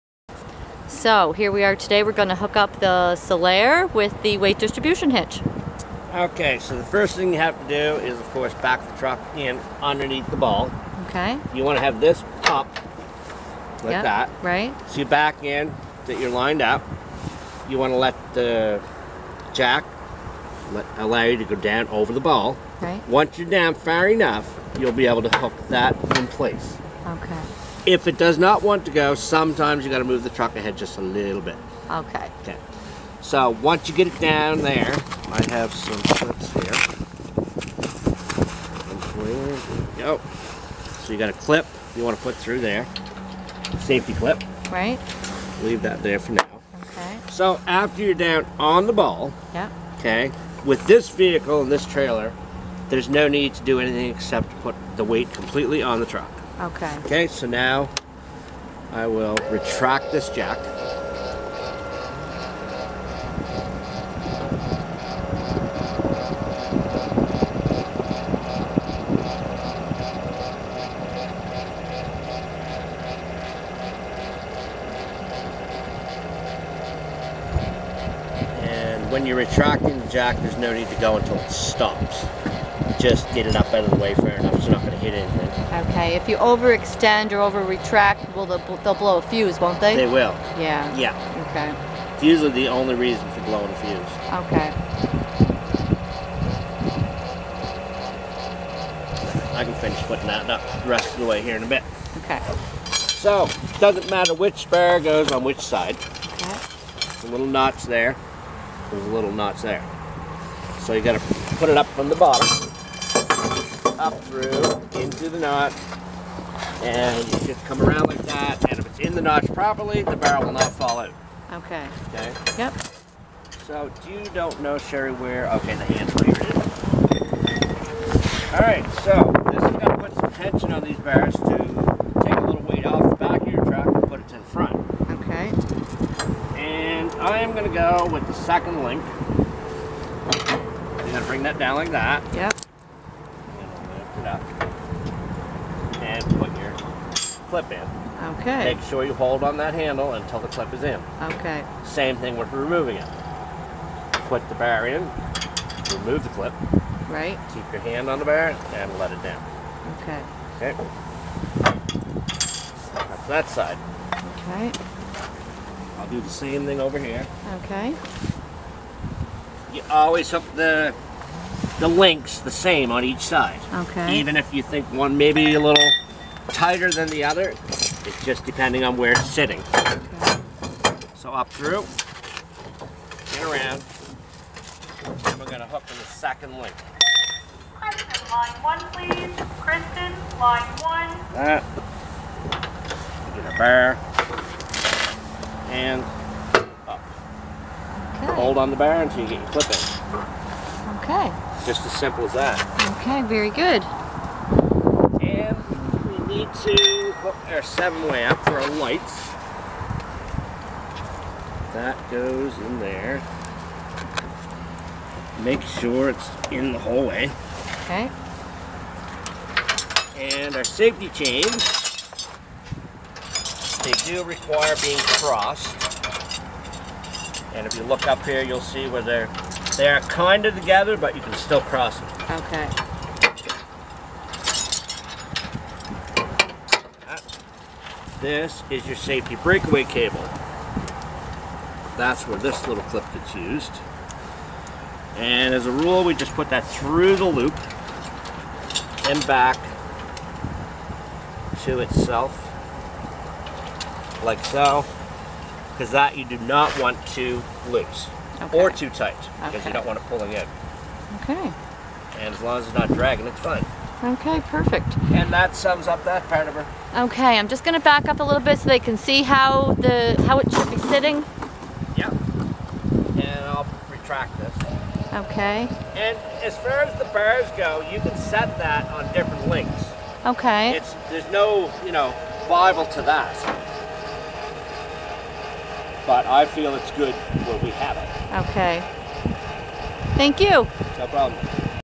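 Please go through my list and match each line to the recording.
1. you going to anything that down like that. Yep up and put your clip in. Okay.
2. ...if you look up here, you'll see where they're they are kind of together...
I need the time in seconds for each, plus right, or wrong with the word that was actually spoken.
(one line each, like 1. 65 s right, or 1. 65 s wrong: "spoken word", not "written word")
1. 139 s wrong: "bring", not "anything"
2. 227 s right.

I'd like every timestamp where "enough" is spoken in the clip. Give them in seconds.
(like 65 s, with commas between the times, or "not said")
24 s, 84 s.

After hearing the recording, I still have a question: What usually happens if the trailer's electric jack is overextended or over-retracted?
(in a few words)
blow a fuse.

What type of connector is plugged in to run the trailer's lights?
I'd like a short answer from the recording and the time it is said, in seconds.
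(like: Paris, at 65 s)
seven way, at 207 s.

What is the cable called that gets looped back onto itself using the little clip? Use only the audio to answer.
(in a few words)
safety breakaway cable.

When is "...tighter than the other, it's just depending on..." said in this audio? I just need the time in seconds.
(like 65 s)
176 s.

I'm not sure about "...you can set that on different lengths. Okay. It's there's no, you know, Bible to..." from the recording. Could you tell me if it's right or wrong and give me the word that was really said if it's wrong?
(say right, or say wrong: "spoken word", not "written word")
right.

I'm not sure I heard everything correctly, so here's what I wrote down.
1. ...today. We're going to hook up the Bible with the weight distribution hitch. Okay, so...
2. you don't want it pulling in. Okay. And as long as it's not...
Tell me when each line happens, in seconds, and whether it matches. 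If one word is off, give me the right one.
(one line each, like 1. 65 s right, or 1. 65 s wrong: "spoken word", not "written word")
1. 1 s wrong: "Solaire", not "Bible"
2. 259 s right.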